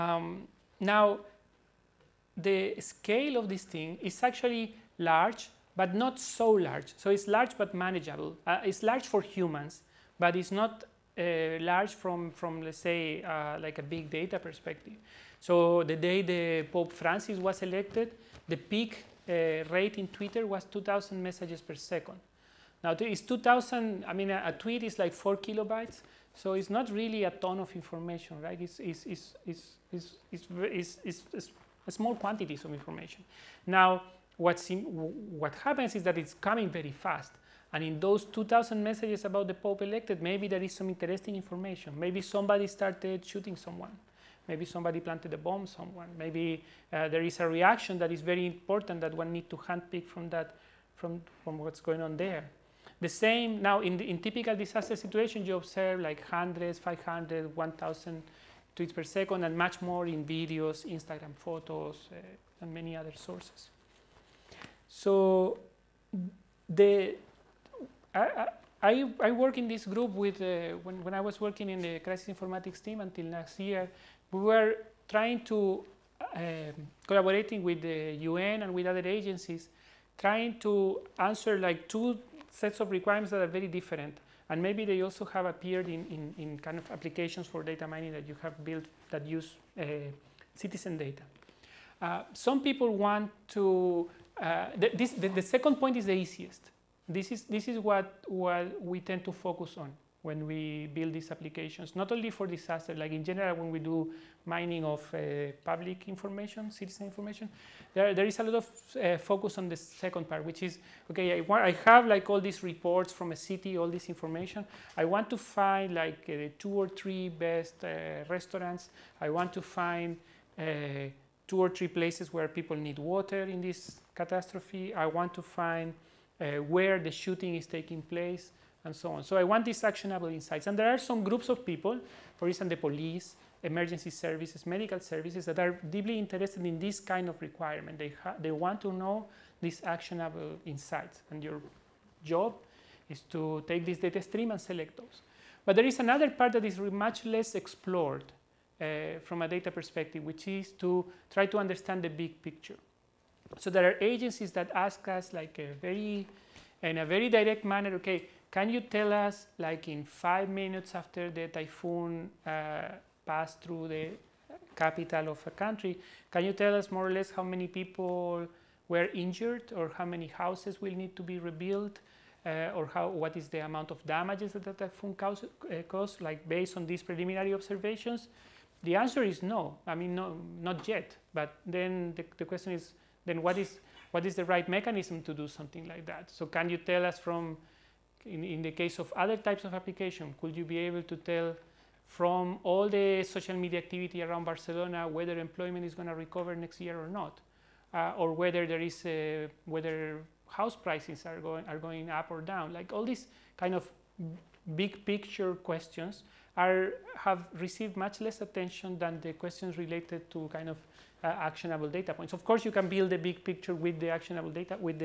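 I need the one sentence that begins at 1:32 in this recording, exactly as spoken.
Uh, some people want to, uh, the, this, the, the second point is the easiest.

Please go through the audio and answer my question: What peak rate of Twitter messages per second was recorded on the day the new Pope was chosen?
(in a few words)
2,000.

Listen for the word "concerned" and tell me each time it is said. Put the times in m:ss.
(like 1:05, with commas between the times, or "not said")
not said.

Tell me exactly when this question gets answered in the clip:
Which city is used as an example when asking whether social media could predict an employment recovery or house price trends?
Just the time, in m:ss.
3:14.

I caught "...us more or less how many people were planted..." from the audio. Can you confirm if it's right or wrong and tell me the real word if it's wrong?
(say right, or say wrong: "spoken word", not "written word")
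wrong: "injured", not "planted".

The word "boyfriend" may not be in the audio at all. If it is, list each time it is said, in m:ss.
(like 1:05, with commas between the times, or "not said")
not said.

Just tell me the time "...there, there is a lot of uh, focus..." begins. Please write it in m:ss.
1:47.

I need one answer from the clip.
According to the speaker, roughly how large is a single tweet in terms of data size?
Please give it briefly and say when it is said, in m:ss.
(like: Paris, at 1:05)
4 kilobytes, at 0:25.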